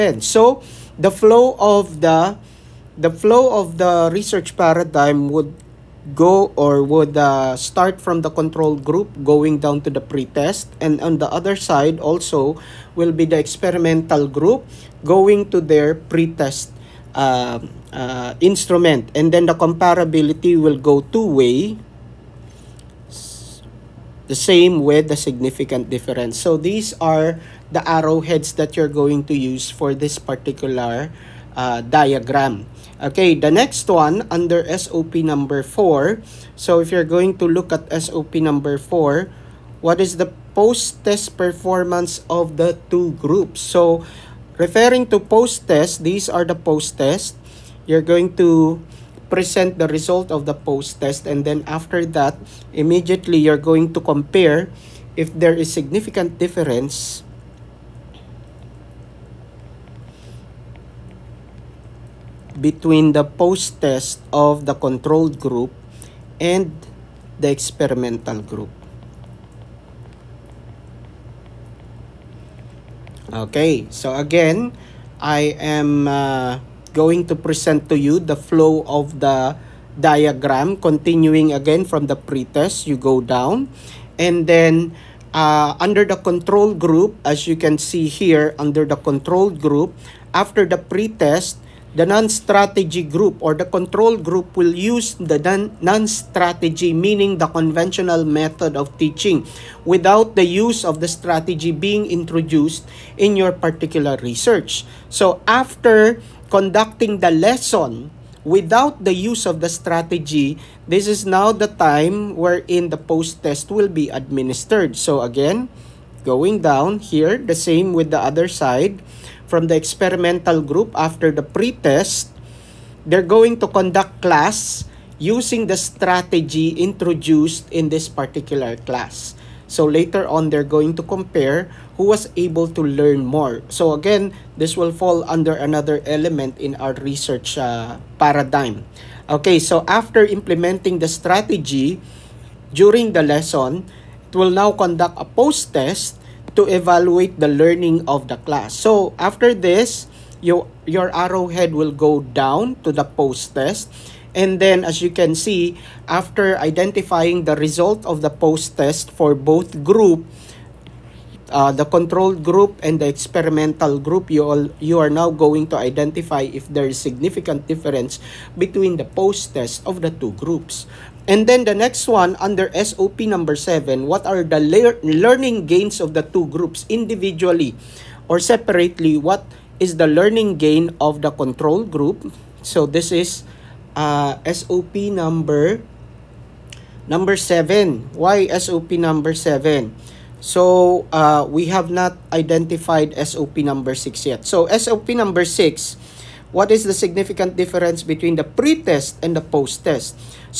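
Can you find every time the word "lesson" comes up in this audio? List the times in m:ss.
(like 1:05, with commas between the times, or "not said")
1:47, 2:23.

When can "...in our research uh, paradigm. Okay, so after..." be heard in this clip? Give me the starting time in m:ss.
2:16.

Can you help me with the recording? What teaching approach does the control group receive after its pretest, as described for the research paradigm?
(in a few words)
conventional method.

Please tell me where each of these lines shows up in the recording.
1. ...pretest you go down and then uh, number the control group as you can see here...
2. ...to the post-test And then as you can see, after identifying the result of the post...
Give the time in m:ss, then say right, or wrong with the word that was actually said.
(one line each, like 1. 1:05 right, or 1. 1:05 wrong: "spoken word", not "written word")
1. 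1:22 wrong: "under", not "number"
2. 2:32 right.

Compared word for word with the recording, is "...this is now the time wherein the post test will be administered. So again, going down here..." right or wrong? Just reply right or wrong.
right.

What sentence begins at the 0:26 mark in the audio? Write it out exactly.
So these are the arrowheads that you're going to use for this particular uh, diagram.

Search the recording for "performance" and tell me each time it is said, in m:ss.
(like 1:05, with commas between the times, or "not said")
0:41.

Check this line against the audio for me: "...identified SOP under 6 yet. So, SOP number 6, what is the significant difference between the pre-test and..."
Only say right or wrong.
wrong.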